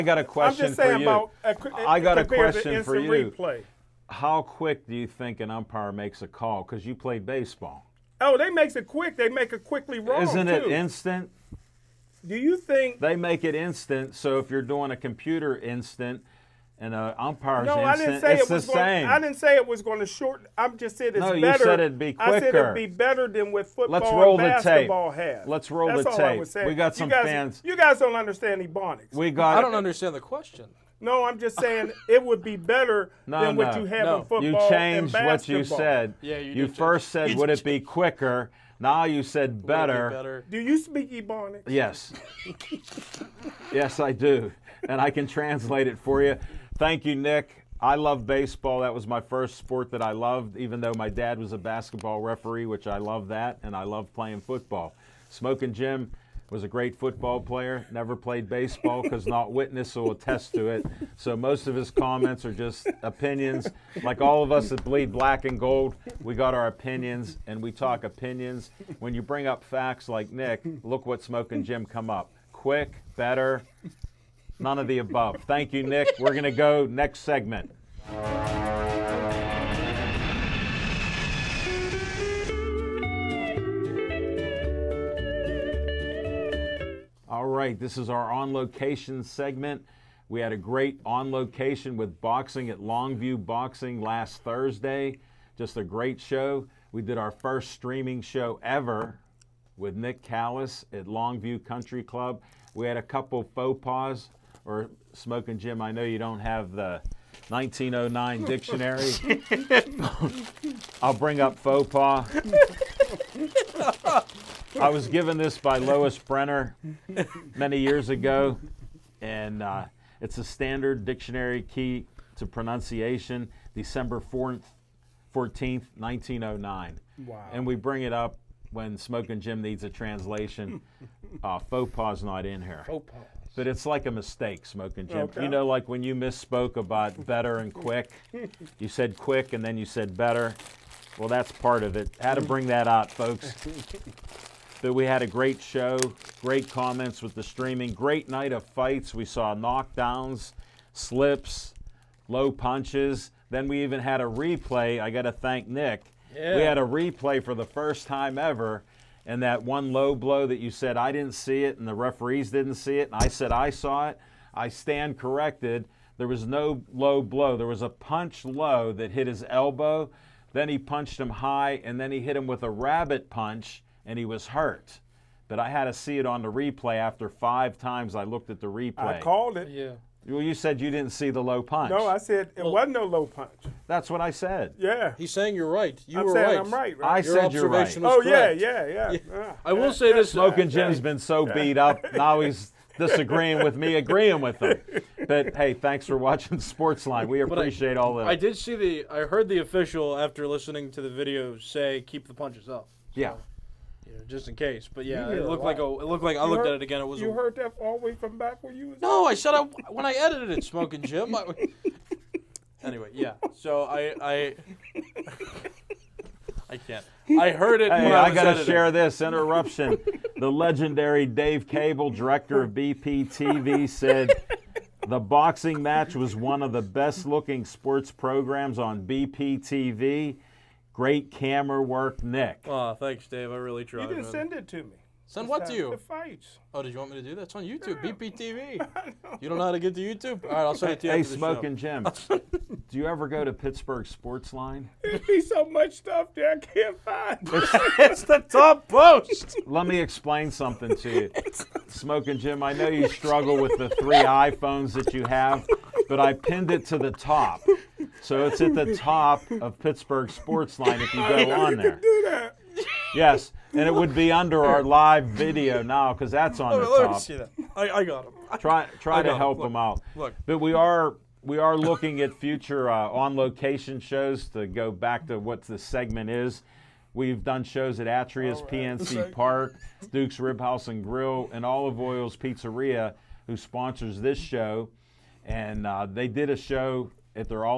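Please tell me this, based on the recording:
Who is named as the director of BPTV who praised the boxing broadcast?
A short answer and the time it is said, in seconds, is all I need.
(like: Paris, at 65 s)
Dave Cable, at 221 s.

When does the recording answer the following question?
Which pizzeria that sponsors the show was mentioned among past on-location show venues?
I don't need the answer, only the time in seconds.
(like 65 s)
281 s.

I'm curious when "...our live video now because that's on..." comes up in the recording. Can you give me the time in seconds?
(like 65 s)
264 s.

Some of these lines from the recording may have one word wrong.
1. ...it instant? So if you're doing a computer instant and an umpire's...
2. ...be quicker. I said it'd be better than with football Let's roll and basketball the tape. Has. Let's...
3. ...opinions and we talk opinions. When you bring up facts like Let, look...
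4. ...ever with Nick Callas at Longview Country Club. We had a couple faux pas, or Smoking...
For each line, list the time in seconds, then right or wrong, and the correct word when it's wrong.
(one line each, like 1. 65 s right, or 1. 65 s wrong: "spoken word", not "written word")
1. 13 s right
2. 21 s right
3. 66 s wrong: "Nick", not "Let"
4. 98 s right.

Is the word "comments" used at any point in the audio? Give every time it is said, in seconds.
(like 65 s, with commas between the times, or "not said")
61 s, 146 s.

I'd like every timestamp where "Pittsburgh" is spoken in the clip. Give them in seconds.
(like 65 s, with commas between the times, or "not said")
243 s, 259 s.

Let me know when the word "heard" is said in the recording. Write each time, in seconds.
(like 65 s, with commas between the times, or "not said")
199 s, 207 s, 217 s.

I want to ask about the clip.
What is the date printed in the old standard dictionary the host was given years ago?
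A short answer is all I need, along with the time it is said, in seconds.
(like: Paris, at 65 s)
December 14th, 1909, at 123 s.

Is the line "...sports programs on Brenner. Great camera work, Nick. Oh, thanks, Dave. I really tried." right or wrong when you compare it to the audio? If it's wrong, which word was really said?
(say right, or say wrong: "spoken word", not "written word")
wrong: "BPTV", not "Brenner".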